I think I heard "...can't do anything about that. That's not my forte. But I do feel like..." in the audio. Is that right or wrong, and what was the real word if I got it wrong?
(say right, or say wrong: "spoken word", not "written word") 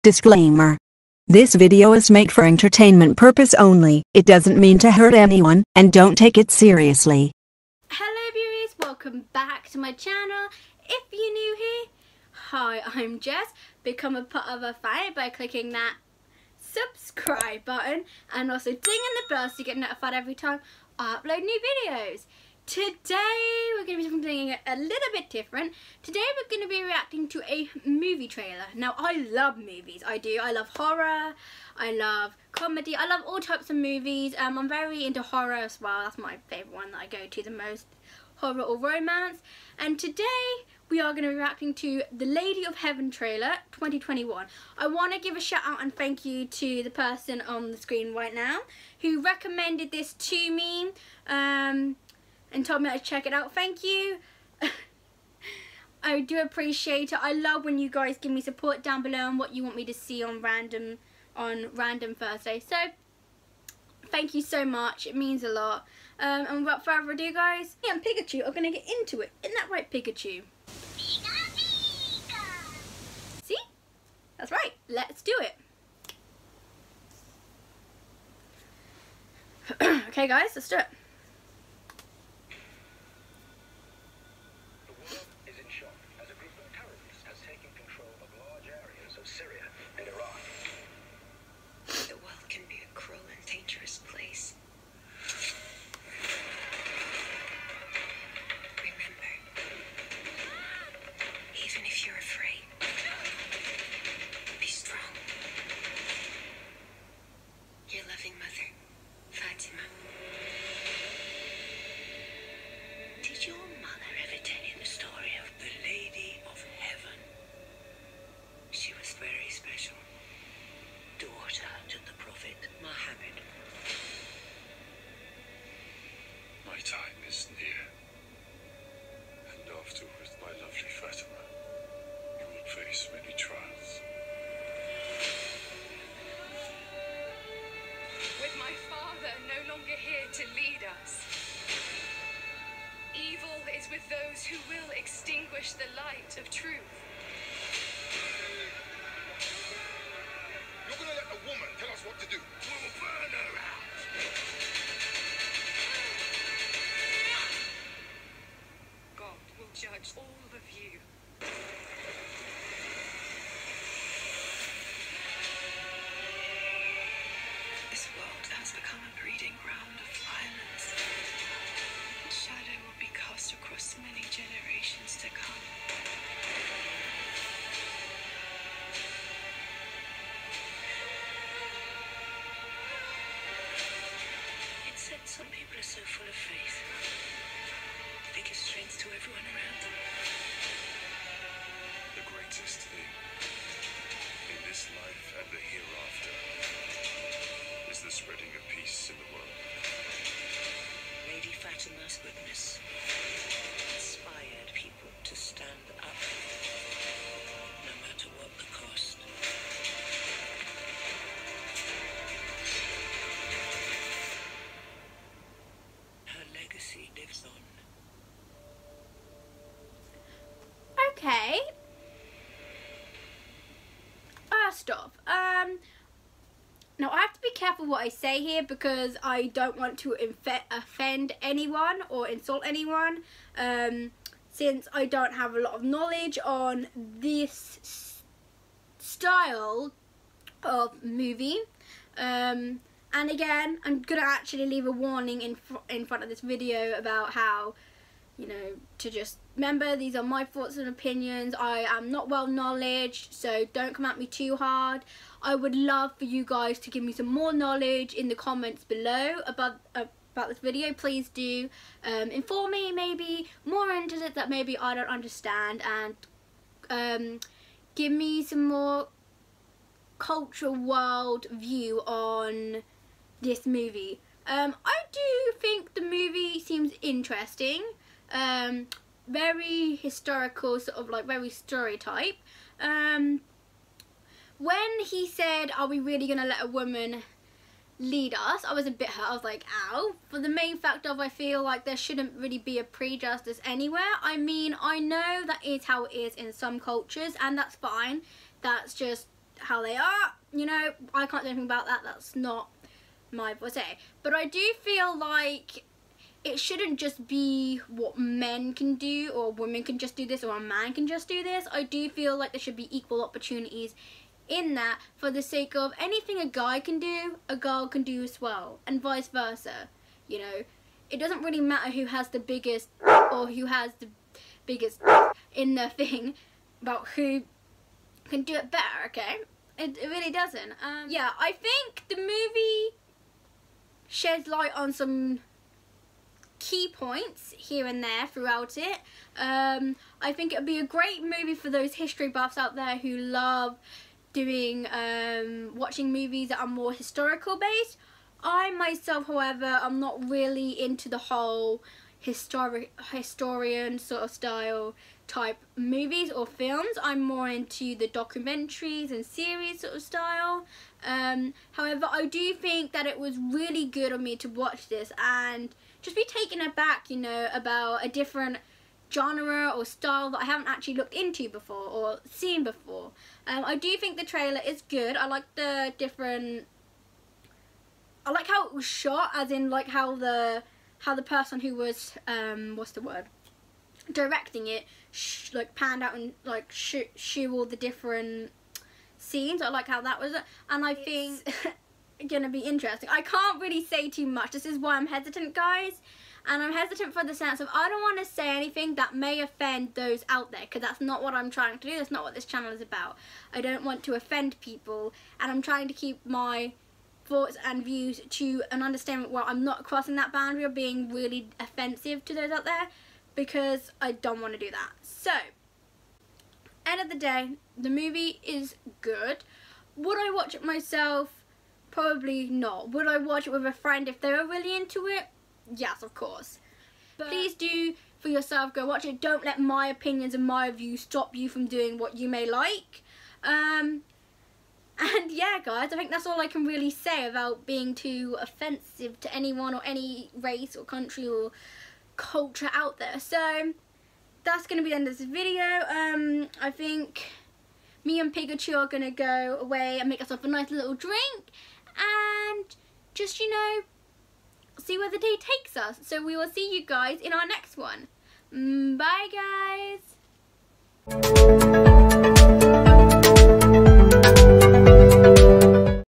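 right.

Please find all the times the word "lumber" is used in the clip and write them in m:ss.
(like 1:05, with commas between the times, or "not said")
not said.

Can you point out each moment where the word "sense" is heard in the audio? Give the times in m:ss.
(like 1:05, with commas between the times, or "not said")
6:37.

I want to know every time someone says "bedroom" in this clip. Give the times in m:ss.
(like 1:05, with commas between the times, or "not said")
not said.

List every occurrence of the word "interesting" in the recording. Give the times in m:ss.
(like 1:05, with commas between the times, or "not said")
4:37, 6:32.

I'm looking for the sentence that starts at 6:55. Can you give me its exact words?
So, end of the day, the movie is good.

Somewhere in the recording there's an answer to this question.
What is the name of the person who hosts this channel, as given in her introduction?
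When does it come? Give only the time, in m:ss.
0:13.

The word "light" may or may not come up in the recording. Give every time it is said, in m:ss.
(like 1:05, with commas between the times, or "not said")
2:25, 5:34.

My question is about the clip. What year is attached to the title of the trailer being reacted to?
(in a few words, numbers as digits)
2021.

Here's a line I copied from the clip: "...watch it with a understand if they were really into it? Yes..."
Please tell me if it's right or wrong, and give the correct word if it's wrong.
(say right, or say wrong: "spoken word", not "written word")
wrong: "friend", not "understand".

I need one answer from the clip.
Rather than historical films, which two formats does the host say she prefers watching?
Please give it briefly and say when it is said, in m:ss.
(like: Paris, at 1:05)
Documentaries and series, at 5:58.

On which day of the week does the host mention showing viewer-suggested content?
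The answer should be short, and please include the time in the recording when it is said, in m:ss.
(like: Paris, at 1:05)
Thursday, at 1:02.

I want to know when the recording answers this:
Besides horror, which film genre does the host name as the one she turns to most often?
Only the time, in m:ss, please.
0:38.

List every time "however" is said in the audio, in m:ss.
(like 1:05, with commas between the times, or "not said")
5:49, 6:01.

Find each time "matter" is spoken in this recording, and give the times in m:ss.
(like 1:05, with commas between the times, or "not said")
5:21.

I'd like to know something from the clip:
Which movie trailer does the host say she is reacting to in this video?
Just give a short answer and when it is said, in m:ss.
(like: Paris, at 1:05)
Lady of Heaven, at 0:42.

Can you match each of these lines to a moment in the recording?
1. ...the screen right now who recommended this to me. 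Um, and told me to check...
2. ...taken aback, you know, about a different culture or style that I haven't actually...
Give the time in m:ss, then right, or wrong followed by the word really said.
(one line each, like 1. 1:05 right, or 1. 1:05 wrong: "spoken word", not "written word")
1. 0:47 right
2. 6:06 wrong: "genre", not "culture".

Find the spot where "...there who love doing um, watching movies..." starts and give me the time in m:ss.
5:42.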